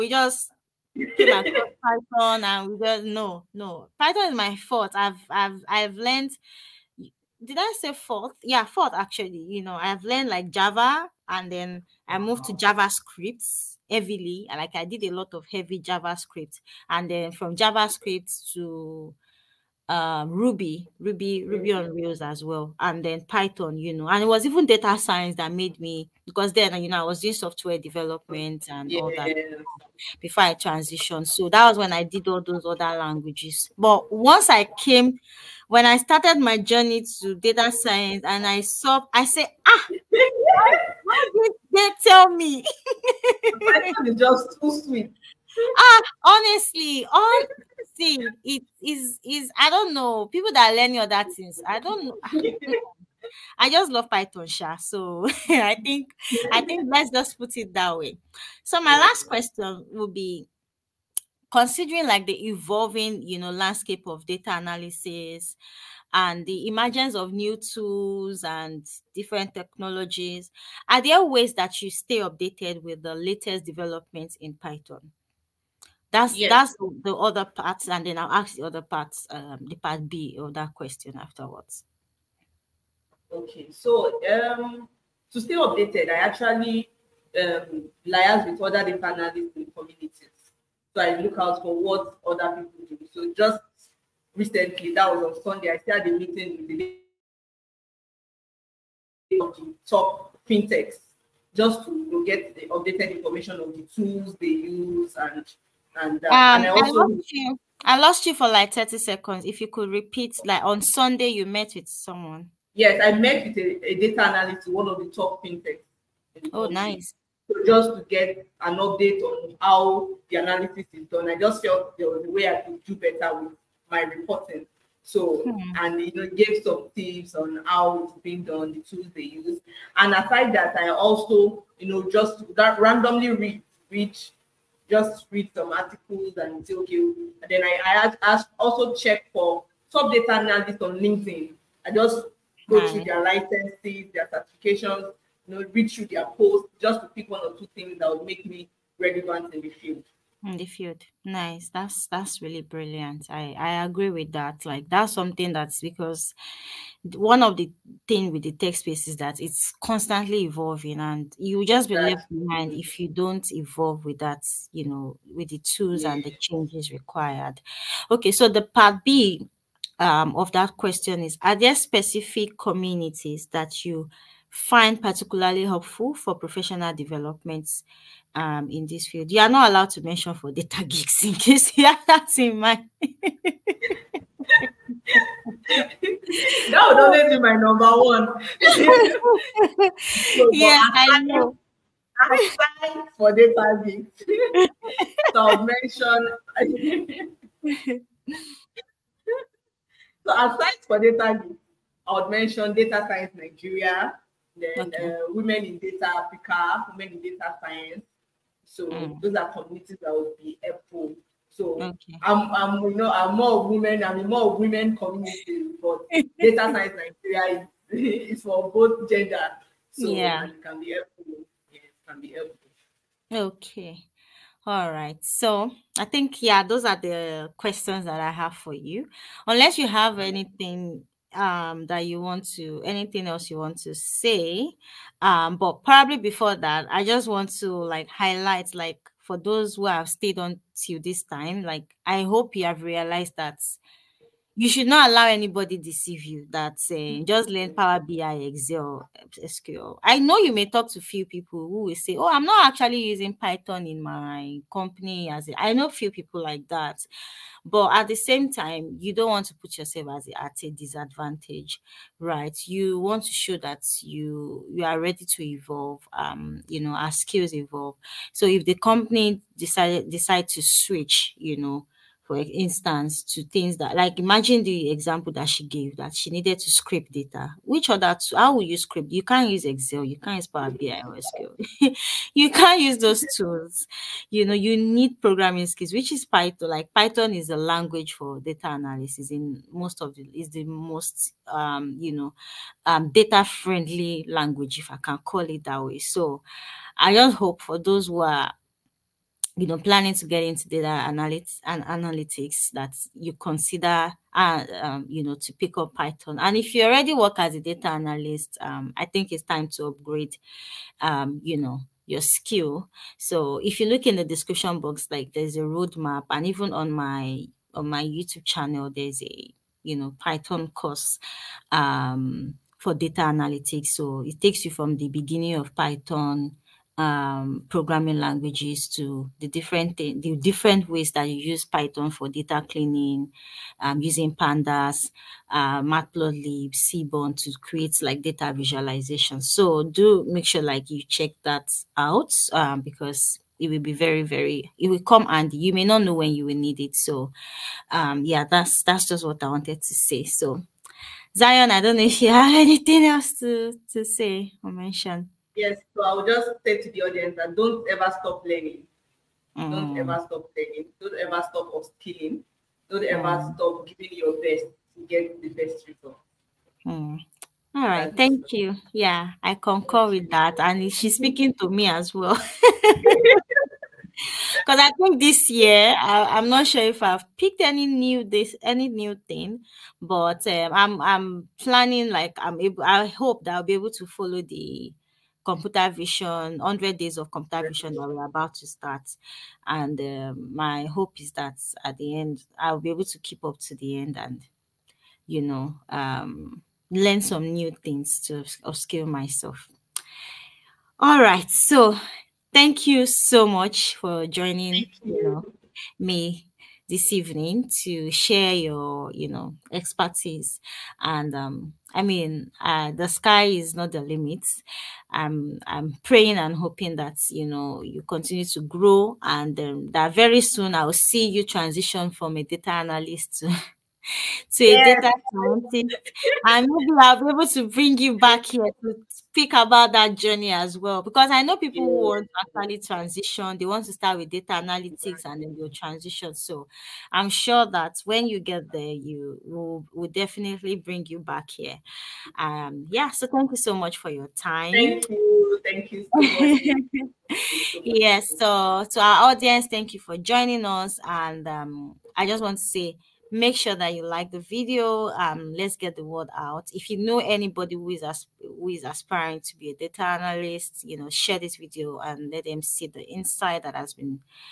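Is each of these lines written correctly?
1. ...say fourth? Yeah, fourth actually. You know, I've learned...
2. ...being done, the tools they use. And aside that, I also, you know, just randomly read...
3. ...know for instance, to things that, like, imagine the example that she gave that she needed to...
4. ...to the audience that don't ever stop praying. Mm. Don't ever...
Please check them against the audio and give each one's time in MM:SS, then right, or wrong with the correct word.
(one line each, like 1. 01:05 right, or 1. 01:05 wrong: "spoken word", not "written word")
1. 00:07 right
2. 02:08 right
3. 04:31 right
4. 05:56 wrong: "learning", not "praying".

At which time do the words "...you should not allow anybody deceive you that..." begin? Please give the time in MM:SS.
04:04.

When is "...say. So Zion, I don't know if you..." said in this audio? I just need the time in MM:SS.
05:49.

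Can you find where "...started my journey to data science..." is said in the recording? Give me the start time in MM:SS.
00:35.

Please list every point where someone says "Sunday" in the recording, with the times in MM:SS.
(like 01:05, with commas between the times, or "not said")
01:35, 01:50.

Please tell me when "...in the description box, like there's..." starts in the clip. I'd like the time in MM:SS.
05:14.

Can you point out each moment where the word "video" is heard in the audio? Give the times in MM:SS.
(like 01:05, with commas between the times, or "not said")
07:34, 07:41.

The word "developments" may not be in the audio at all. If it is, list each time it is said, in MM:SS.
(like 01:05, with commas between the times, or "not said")
00:27, 01:13, 02:56.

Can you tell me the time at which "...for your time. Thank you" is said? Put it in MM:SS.
07:23.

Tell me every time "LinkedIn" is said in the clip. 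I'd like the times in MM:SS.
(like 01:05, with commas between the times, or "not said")
02:20.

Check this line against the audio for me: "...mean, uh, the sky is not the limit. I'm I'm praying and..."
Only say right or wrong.
right.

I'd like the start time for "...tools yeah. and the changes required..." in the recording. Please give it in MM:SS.
02:45.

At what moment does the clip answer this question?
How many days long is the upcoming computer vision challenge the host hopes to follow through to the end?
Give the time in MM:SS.
06:26.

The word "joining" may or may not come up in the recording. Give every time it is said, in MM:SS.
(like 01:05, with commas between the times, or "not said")
06:44, 07:30.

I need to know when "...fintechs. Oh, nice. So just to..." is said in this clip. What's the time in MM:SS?
01:55.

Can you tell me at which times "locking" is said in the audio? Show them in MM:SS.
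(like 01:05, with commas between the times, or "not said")
not said.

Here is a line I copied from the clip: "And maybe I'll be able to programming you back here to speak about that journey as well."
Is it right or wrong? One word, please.
wrong.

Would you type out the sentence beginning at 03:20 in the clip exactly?
so aside for data geeks, I would mention Data Science Nigeria, then okay.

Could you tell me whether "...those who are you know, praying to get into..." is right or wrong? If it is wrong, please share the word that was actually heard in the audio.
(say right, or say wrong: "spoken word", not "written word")
wrong: "planning", not "praying".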